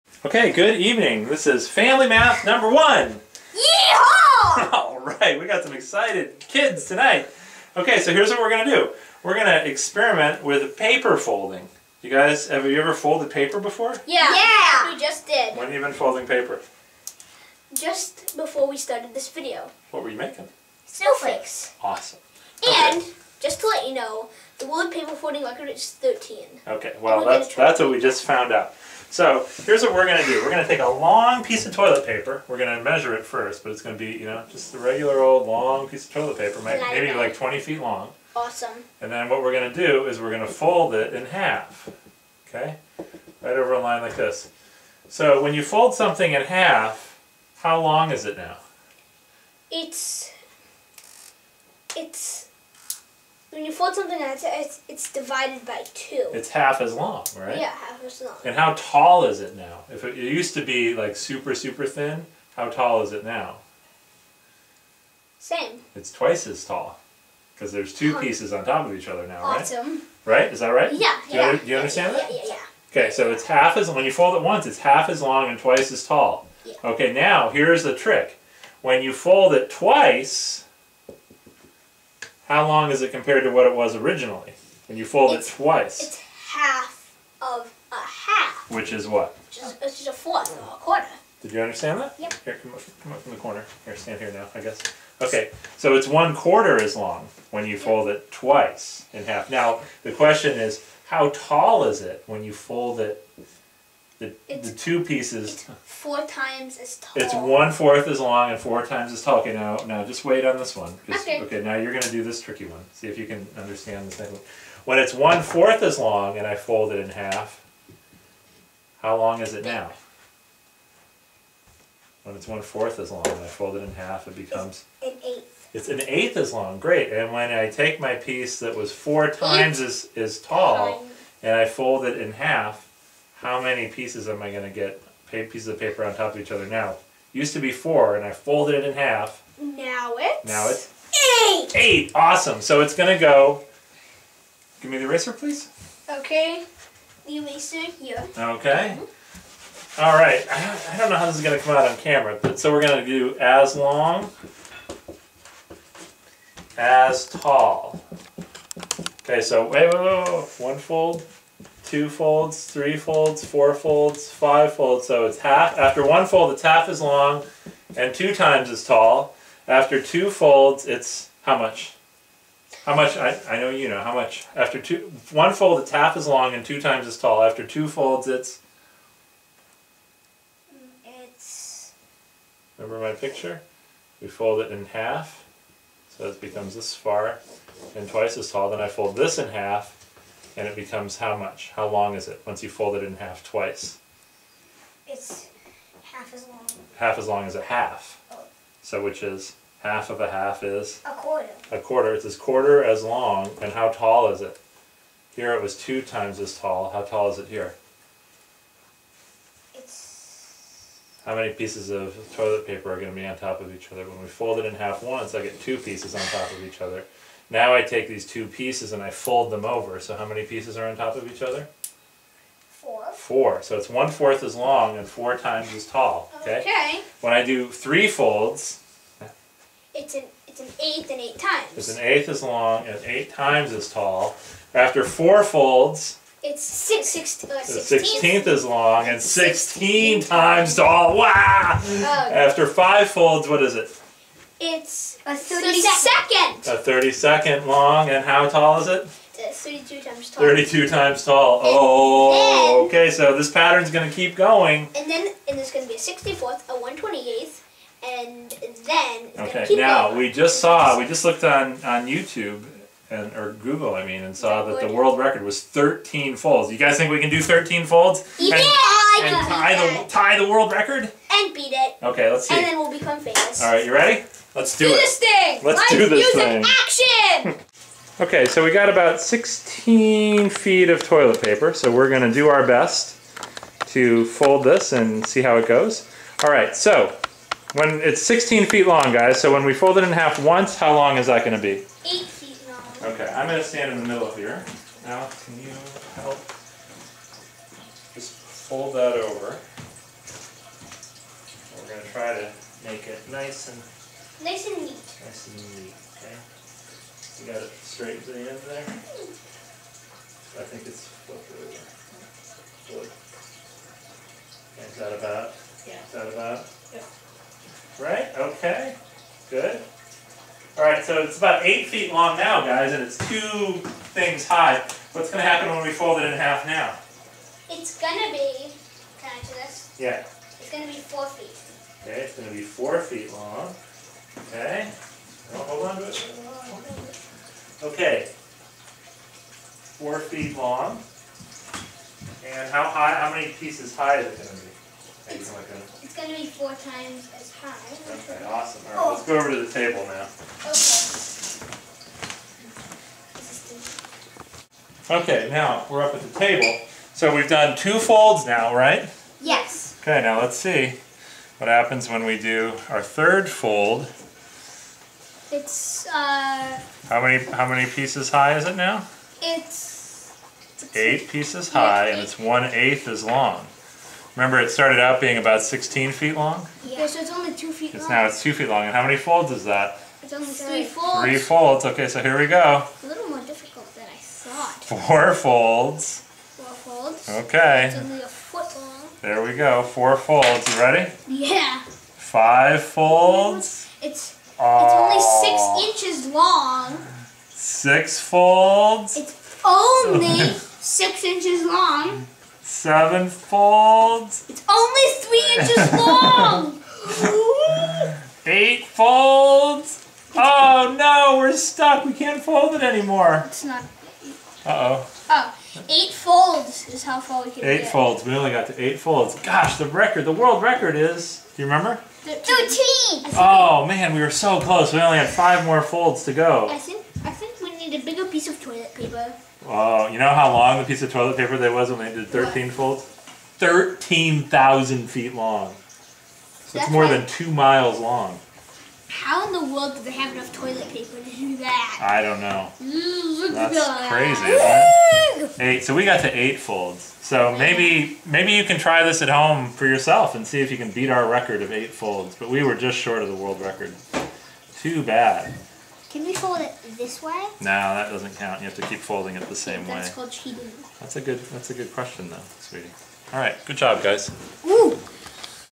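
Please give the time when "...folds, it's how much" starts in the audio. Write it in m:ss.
2:50.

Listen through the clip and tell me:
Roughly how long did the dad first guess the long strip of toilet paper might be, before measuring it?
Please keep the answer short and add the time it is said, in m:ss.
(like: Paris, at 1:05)
20 feet, at 0:37.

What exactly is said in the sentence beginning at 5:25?
What's going to happen when we fold it in half now?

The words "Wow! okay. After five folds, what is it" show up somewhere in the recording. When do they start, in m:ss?
4:01.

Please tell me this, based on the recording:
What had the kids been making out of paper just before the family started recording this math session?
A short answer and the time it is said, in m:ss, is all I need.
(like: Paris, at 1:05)
Snowflakes, at 0:20.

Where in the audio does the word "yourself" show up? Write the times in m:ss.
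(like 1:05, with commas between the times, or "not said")
7:29.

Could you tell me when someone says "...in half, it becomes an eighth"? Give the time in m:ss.
2:03.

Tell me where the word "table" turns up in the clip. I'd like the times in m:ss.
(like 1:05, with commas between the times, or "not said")
5:49, 5:56.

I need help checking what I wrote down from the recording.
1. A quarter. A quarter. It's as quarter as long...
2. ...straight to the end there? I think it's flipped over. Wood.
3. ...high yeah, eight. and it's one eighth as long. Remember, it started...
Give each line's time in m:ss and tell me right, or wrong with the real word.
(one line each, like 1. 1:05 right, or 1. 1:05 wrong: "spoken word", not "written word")
1. 3:21 right
2. 5:07 right
3. 6:11 right.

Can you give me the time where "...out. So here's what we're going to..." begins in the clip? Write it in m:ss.
0:28.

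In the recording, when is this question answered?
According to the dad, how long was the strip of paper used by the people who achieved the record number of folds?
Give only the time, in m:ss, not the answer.
7:13.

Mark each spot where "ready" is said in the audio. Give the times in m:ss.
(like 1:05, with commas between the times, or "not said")
4:33, 6:30.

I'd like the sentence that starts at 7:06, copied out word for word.
I think, I think we need a bigger piece of toilet paper.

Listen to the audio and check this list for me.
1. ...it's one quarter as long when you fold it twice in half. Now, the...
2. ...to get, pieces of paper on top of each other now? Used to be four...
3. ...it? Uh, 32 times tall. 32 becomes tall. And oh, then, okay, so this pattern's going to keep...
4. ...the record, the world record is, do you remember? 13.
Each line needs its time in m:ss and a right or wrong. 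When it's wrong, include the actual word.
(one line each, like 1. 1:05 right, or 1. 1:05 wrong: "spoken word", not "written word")
1. 1:35 right
2. 2:14 right
3. 4:08 wrong: "times", not "becomes"
4. 6:59 right.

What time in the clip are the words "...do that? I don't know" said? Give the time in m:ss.
7:21.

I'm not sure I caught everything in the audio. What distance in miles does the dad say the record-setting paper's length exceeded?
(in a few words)
2 miles.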